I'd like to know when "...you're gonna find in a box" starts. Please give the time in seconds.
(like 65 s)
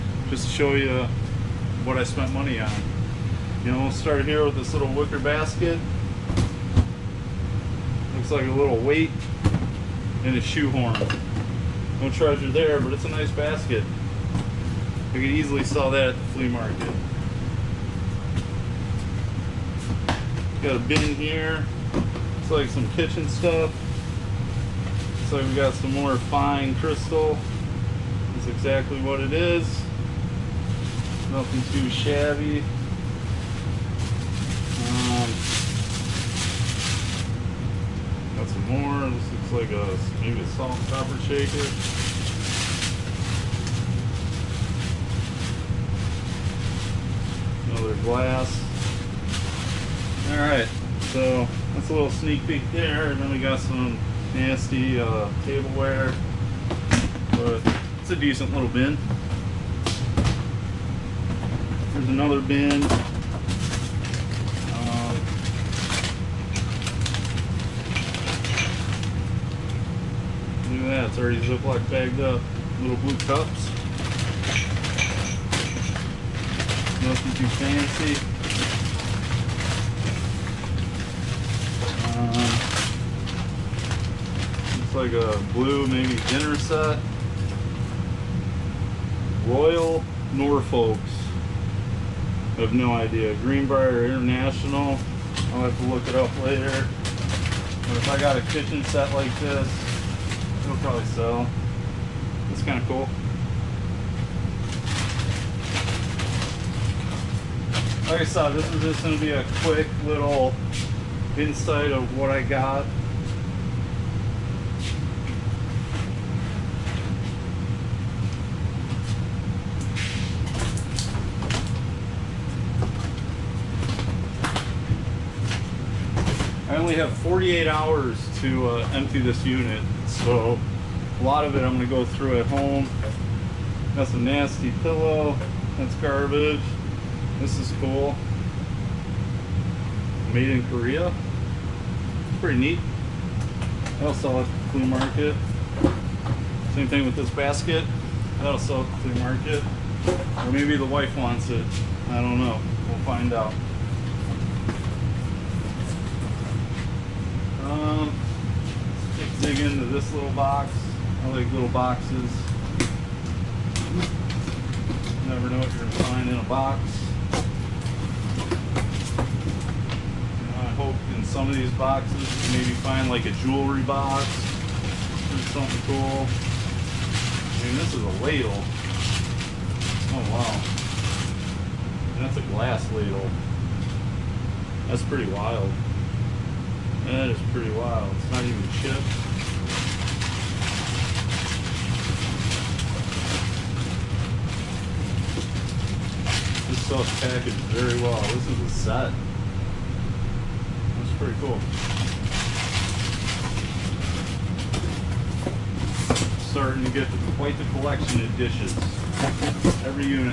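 165 s.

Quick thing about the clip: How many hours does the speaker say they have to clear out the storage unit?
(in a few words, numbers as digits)
48.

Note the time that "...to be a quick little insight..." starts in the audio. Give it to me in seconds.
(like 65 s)
109 s.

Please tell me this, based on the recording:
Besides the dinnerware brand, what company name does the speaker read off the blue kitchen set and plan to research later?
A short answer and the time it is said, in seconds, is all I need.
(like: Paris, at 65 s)
Greenbrier International, at 93 s.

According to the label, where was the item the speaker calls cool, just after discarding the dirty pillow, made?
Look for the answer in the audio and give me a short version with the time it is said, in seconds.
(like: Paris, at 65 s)
Korea, at 140 s.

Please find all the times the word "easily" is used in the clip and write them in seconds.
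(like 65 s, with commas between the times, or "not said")
15 s.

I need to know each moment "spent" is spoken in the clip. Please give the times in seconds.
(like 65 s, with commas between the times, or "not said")
2 s.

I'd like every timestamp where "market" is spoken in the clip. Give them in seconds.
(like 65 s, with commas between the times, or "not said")
16 s, 144 s, 149 s.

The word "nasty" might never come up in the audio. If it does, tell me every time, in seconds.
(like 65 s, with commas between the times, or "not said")
54 s, 134 s.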